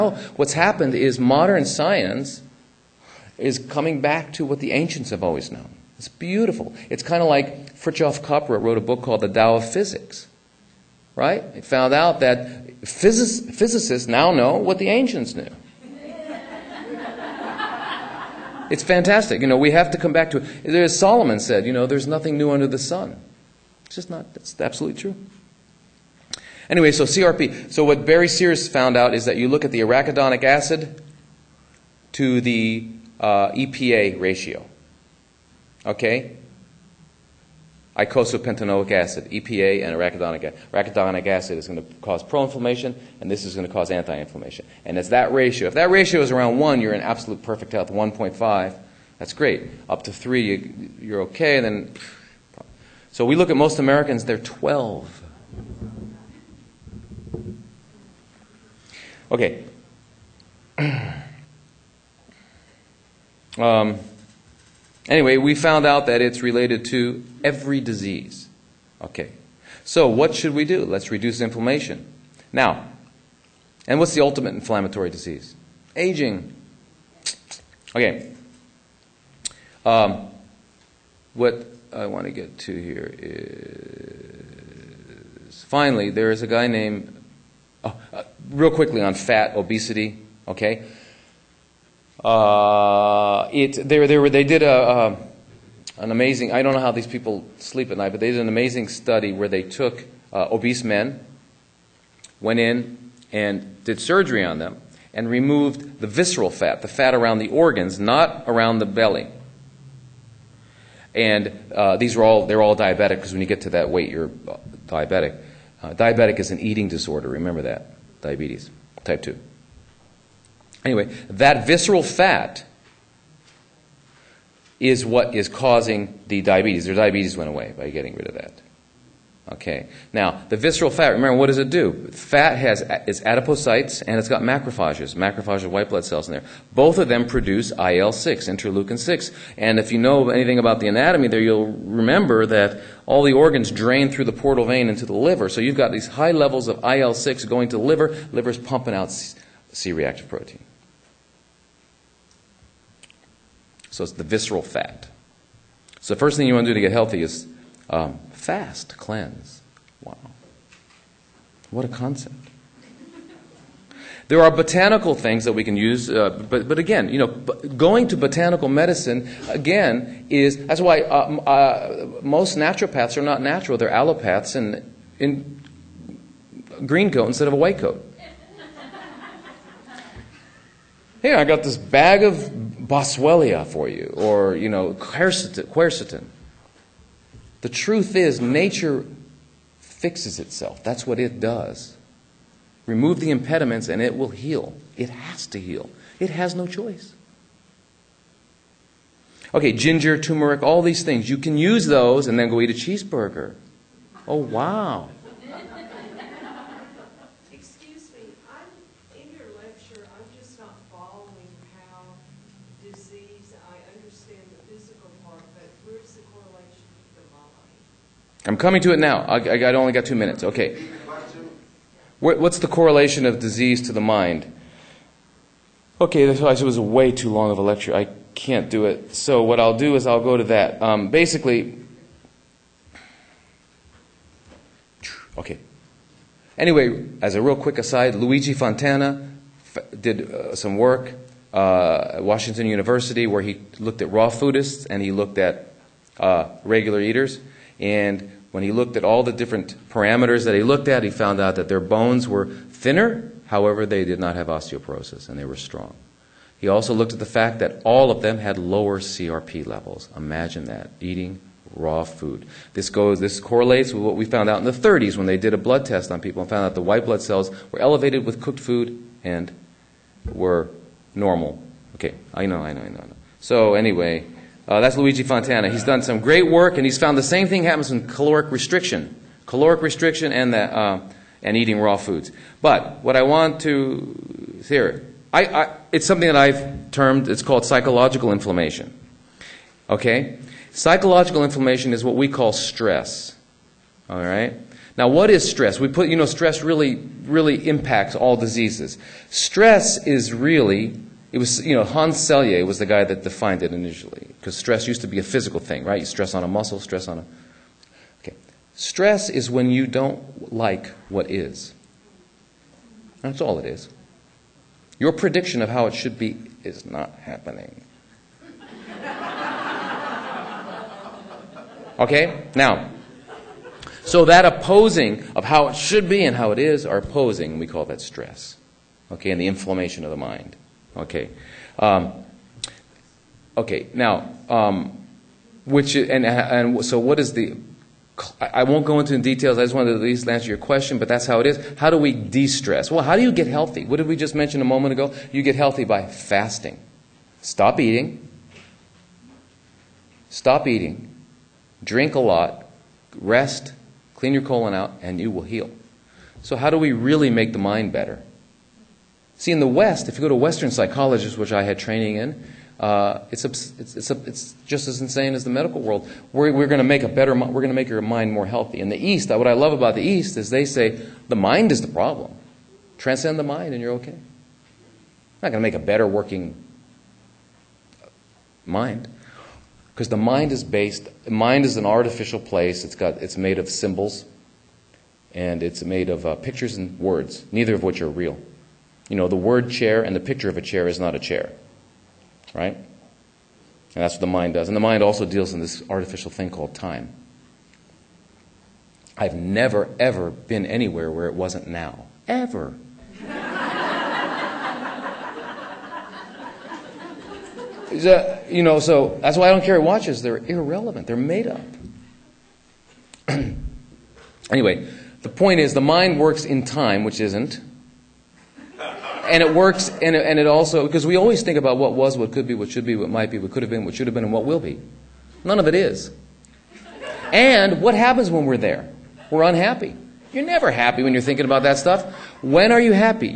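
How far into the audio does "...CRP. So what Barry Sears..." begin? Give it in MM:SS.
00:27.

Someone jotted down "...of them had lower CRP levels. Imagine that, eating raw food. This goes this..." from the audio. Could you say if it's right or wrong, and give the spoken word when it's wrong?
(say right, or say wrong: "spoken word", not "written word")
right.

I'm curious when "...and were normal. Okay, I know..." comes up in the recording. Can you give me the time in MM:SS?
04:29.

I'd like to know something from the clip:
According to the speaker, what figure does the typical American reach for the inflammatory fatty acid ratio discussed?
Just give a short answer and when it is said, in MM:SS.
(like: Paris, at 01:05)
12, at 00:54.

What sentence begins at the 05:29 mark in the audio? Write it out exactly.
Okay, and the inflammation of the mind.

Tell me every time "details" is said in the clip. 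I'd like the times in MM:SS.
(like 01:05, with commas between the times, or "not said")
05:39.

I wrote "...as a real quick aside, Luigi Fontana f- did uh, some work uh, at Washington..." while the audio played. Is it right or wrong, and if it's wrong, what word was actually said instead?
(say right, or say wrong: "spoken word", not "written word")
right.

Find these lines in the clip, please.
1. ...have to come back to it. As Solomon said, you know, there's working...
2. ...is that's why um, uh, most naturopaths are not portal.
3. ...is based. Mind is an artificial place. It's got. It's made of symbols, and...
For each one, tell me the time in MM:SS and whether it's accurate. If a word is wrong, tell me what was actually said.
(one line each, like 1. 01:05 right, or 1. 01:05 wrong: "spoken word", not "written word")
1. 00:19 wrong: "nothing", not "working"
2. 02:50 wrong: "natural", not "portal"
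3. 06:20 right.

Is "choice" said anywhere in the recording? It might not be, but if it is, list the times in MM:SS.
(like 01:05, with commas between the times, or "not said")
03:16.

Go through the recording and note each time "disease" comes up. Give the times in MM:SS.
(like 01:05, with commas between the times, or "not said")
01:07, 01:15, 03:43, 04:58.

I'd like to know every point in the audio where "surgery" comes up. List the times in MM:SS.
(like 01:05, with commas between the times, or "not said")
01:44.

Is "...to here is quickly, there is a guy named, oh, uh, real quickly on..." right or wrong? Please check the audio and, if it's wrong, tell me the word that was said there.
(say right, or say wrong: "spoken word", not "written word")
wrong: "finally", not "quickly".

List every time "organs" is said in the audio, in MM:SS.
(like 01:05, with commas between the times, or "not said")
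01:47, 02:23.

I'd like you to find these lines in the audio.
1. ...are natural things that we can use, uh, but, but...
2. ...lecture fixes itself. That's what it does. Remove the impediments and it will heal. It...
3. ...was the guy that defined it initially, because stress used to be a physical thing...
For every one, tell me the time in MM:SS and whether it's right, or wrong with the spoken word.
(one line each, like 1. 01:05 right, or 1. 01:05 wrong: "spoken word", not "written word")
1. 02:44 wrong: "botanical", not "natural"
2. 03:08 wrong: "nature", not "lecture"
3. 05:02 right.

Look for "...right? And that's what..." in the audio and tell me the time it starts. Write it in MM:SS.
06:32.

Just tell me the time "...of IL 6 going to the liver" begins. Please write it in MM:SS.
02:26.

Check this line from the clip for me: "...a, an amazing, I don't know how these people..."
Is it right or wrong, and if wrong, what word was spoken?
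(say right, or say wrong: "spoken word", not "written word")
right.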